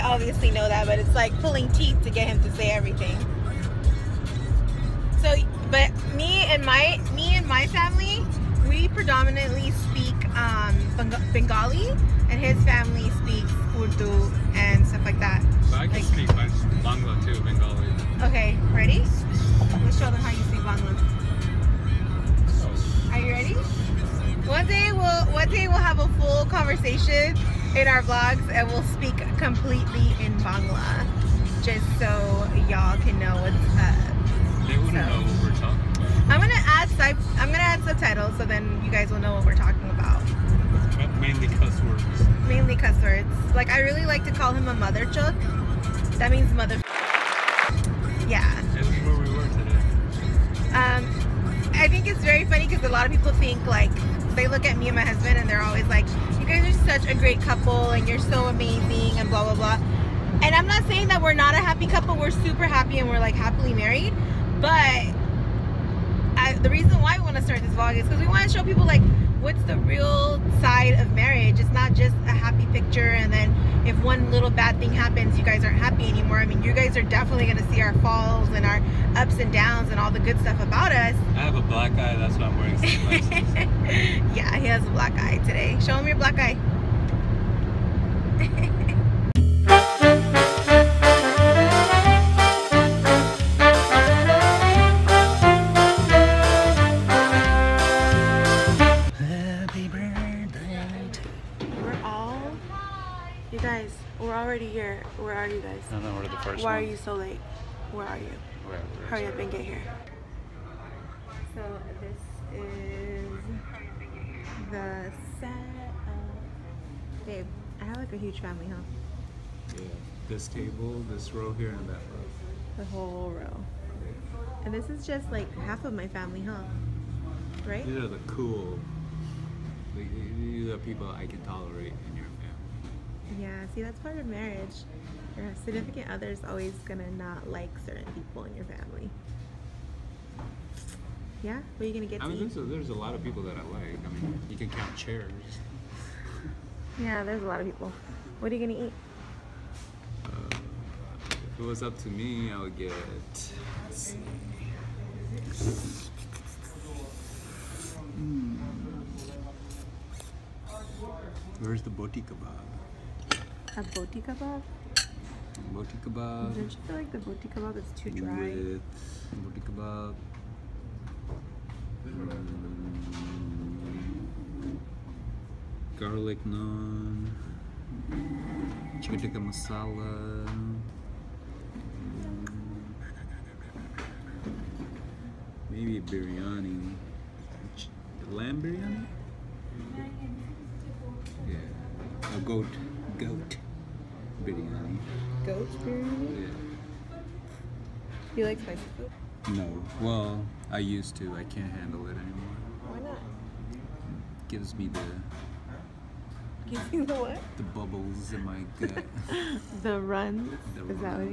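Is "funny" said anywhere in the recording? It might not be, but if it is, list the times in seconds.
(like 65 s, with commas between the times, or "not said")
52 s.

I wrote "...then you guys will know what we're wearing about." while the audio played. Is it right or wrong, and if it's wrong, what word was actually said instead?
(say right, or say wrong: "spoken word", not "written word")
wrong: "talking", not "wearing".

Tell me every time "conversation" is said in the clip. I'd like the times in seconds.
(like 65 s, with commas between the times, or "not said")
26 s.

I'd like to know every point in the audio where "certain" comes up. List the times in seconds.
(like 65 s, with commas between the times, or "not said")
137 s.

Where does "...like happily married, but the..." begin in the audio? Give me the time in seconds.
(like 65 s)
63 s.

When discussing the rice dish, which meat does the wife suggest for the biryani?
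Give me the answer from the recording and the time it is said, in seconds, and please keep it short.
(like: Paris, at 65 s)
Lamb, at 188 s.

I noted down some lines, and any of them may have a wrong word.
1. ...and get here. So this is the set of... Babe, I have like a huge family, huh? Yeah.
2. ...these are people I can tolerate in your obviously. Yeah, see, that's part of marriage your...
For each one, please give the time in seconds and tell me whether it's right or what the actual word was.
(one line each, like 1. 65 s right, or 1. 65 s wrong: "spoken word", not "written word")
1. 109 s right
2. 130 s wrong: "family", not "obviously".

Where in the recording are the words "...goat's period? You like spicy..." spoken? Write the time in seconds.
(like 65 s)
195 s.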